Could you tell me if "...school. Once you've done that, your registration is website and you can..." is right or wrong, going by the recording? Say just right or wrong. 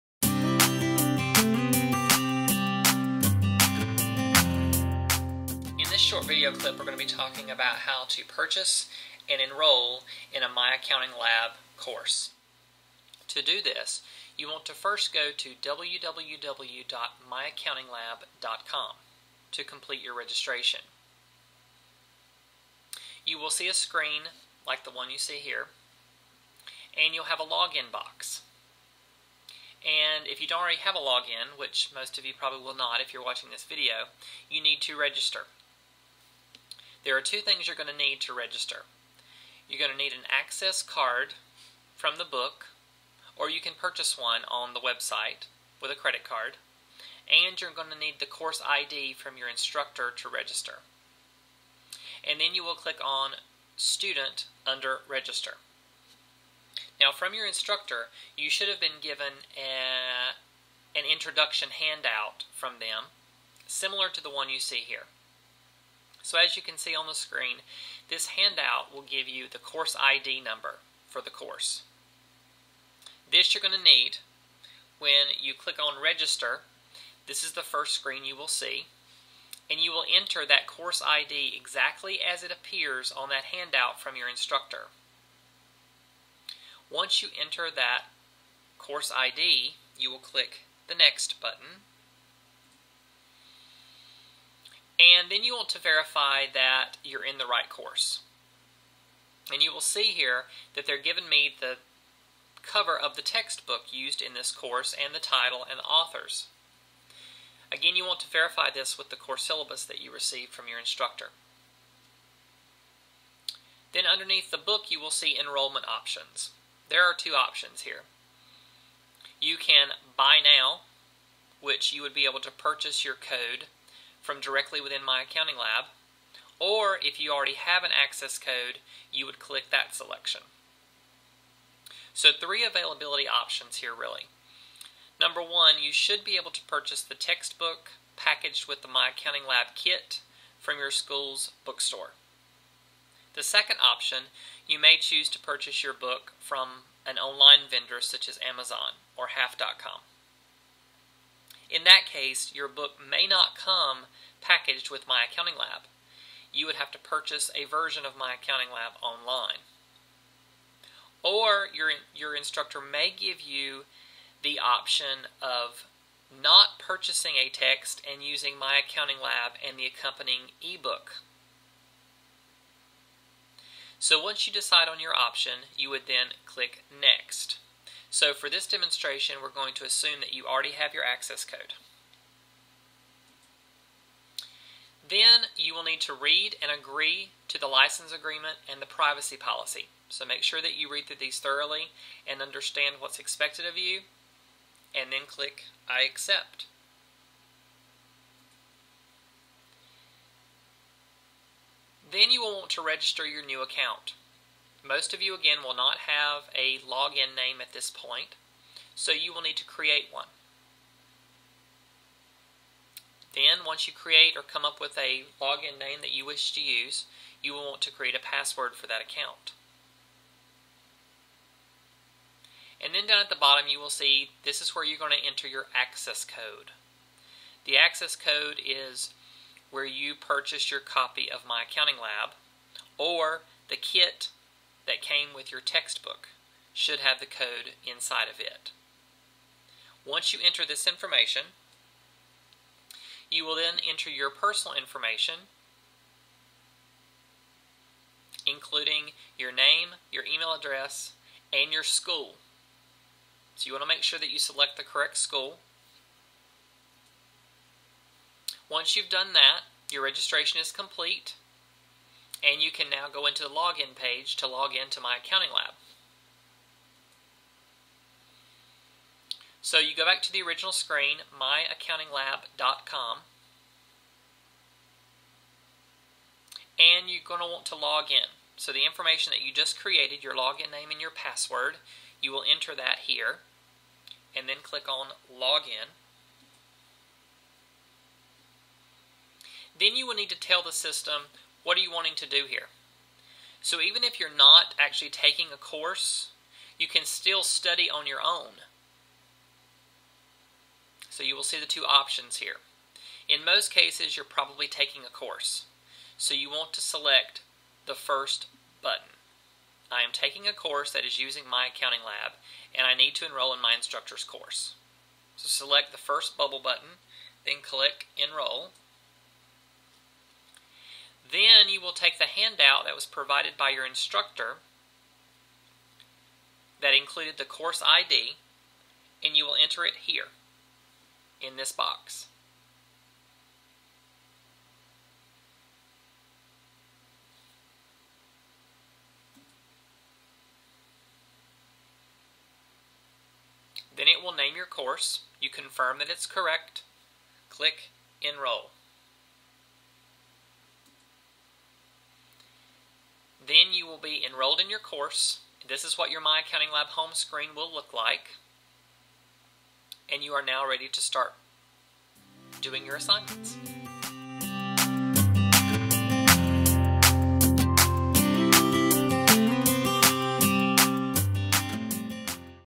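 wrong.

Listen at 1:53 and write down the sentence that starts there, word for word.
Then underneath the book, you will see enrollment options.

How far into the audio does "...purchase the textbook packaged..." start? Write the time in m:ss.
2:16.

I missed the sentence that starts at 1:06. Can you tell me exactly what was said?
So as you can see on the screen, this handout will give you the course ID number for the course.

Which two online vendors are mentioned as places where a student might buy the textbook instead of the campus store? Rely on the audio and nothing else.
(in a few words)
Amazon or Half.com.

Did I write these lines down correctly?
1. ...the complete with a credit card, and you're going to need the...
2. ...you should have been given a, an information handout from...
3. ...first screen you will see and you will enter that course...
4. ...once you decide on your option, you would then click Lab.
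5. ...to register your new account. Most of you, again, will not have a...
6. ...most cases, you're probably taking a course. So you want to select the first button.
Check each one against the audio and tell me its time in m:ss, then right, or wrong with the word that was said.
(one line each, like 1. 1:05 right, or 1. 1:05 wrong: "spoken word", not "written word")
1. 0:44 wrong: "website", not "complete"
2. 0:58 wrong: "introduction", not "information"
3. 1:17 right
4. 2:54 wrong: "Next", not "Lab"
5. 3:22 right
6. 5:03 right.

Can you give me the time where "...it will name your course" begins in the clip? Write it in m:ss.
5:44.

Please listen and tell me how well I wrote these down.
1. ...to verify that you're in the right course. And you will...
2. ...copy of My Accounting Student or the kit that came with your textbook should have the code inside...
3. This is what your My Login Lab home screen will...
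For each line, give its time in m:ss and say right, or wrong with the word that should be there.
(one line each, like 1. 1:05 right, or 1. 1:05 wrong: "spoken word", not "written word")
1. 1:35 right
2. 3:50 wrong: "Lab", not "Student"
3. 5:55 wrong: "Accounting", not "Login".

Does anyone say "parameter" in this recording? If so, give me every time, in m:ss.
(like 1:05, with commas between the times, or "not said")
not said.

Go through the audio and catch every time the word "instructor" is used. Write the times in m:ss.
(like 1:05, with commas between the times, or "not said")
0:49, 0:57, 1:24, 1:50, 2:42, 5:13, 5:23.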